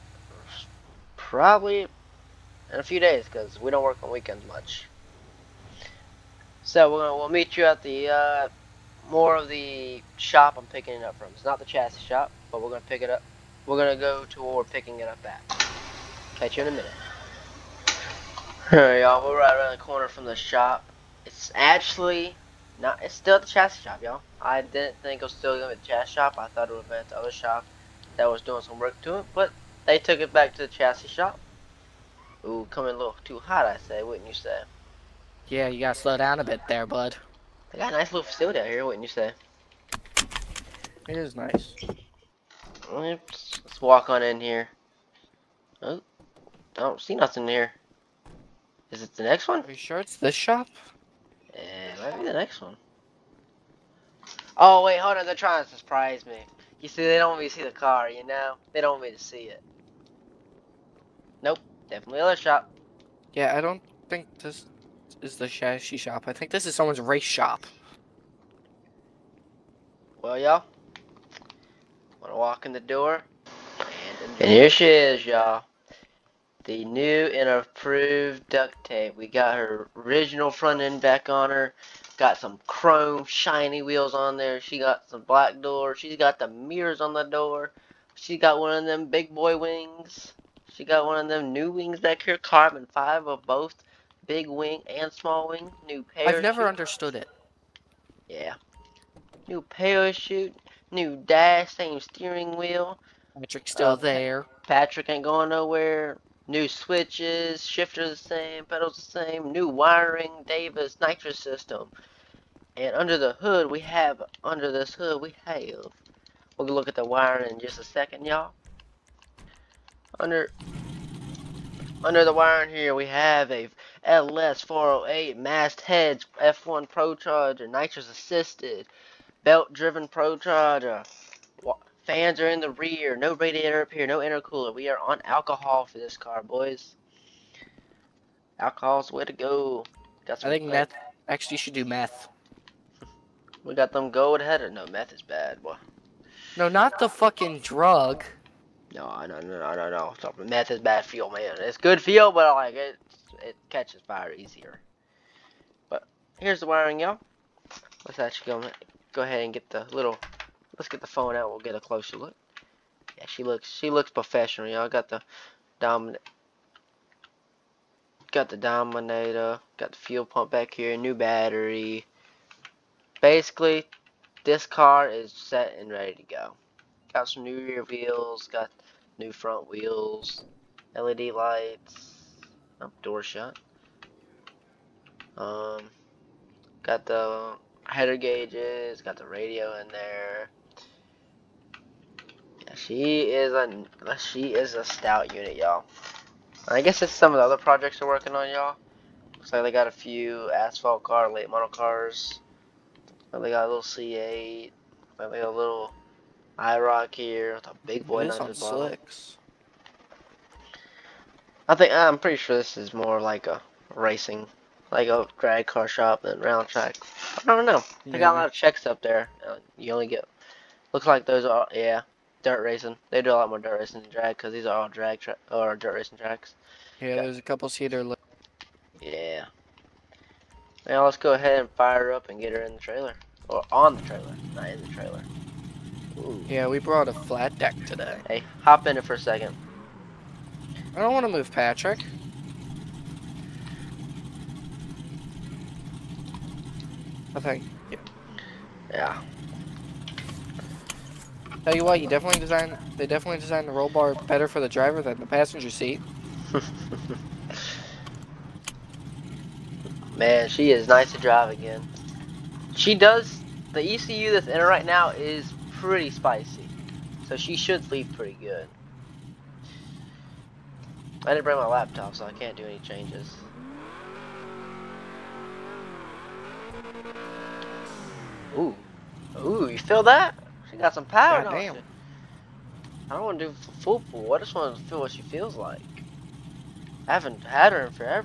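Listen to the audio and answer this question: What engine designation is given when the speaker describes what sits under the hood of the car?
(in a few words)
LS408.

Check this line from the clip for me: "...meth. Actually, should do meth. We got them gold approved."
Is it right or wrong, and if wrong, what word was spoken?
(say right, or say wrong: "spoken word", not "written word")
wrong: "headed", not "approved".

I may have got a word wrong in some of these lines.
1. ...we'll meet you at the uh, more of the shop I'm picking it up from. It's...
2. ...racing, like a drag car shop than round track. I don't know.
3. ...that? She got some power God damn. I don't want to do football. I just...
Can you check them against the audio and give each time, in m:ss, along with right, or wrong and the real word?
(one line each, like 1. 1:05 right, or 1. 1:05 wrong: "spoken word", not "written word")
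1. 0:07 right
2. 3:33 right
3. 4:40 right.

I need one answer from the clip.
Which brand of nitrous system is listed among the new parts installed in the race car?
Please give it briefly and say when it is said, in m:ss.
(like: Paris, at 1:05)
Davis, at 1:50.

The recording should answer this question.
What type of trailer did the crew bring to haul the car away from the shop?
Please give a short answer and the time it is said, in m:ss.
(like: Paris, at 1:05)
Flat deck, at 3:57.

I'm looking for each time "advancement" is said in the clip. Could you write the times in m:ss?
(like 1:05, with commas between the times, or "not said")
not said.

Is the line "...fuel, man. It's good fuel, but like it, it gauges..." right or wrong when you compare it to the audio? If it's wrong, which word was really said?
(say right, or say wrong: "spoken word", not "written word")
wrong: "catches", not "gauges".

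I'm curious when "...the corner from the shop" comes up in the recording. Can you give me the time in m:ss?
0:19.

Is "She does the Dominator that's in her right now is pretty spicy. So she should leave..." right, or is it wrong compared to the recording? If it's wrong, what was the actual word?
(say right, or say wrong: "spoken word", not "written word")
wrong: "ECU", not "Dominator".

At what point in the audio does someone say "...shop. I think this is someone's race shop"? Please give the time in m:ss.
1:05.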